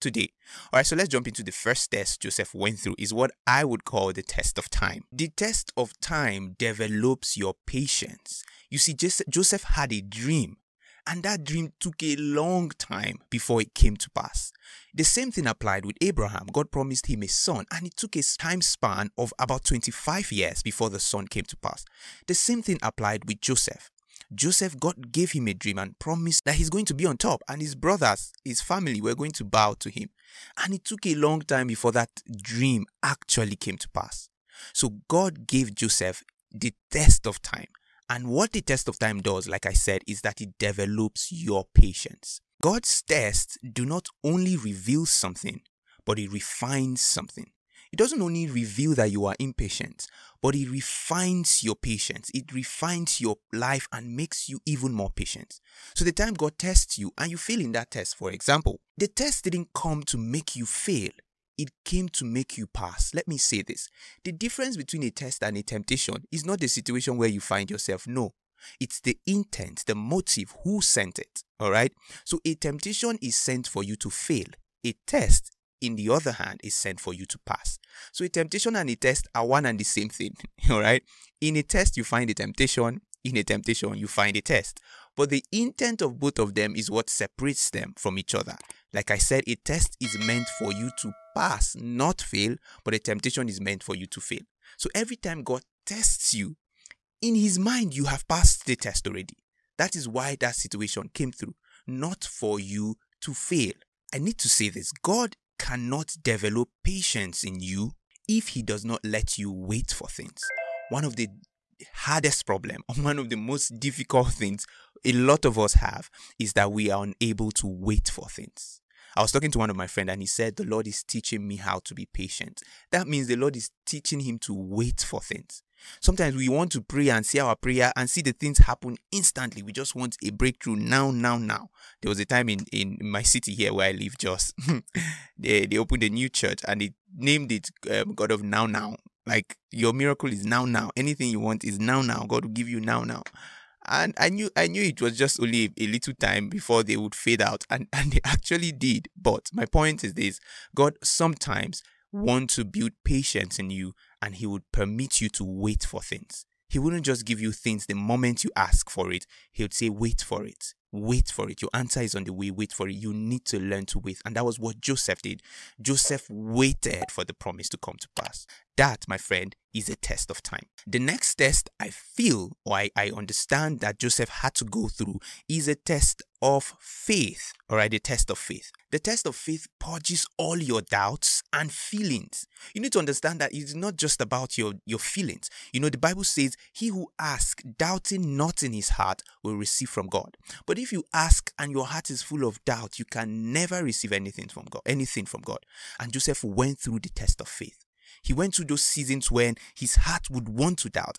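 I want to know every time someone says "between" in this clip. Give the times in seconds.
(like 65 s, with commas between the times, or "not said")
64 s.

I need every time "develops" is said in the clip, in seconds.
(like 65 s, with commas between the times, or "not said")
6 s, 40 s, 106 s.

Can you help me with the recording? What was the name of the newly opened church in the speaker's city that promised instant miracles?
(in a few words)
God of Now Now.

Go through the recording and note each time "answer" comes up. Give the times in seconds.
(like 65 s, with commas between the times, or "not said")
161 s.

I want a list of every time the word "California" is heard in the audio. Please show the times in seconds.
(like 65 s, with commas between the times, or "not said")
not said.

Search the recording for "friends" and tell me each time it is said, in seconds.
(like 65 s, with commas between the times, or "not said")
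119 s, 169 s.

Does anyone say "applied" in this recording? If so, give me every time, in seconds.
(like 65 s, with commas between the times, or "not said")
15 s, 22 s.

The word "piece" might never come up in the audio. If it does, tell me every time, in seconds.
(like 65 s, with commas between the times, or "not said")
not said.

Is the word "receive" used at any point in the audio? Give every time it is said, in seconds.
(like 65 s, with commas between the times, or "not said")
189 s, 193 s.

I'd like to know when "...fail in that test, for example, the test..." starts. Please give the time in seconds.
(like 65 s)
57 s.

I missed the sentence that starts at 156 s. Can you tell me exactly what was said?
He wouldn't just give you things the moment you ask for it.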